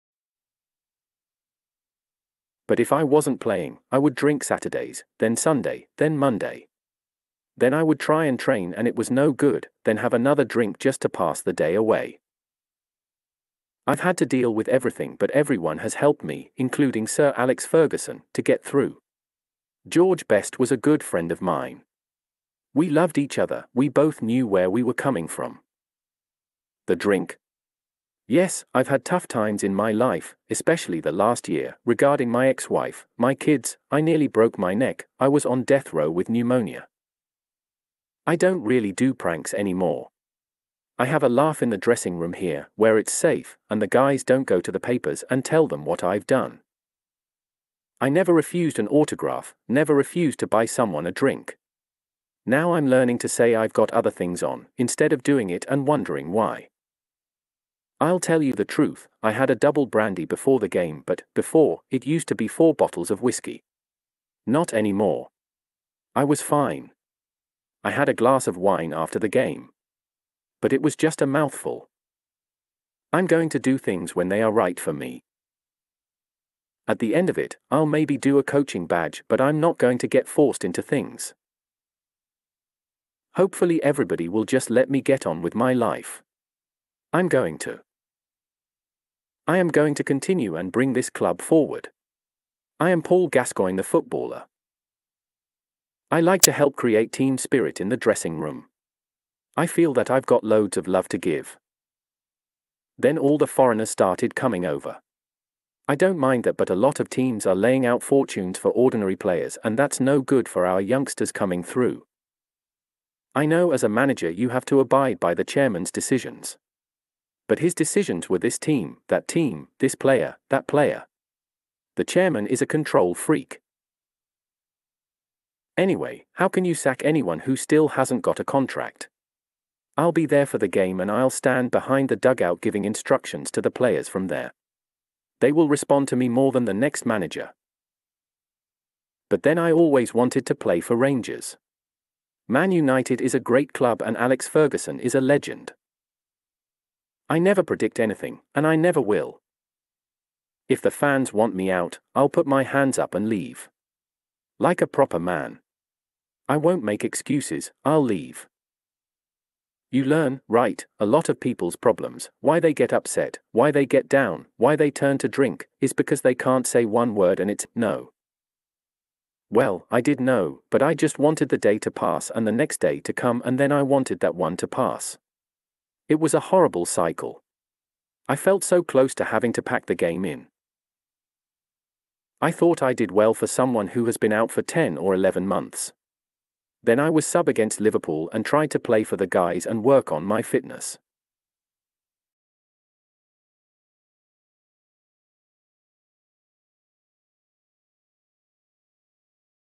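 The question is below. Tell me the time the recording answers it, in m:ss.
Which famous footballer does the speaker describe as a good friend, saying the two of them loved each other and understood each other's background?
0:19.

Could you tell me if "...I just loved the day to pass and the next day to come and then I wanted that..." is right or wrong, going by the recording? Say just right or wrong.
wrong.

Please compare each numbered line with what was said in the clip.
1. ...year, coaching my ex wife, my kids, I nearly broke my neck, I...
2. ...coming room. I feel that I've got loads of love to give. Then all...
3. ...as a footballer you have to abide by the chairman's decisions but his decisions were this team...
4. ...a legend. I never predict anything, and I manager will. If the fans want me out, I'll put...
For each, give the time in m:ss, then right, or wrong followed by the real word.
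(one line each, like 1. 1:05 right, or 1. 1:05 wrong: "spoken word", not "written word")
1. 0:31 wrong: "regarding", not "coaching"
2. 1:37 wrong: "dressing", not "coming"
3. 1:53 wrong: "manager", not "footballer"
4. 2:25 wrong: "never", not "manager".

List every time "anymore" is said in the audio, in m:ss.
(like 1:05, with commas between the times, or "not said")
0:39, 1:04.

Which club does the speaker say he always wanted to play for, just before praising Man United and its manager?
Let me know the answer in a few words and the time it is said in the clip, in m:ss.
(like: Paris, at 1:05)
Rangers, at 2:20.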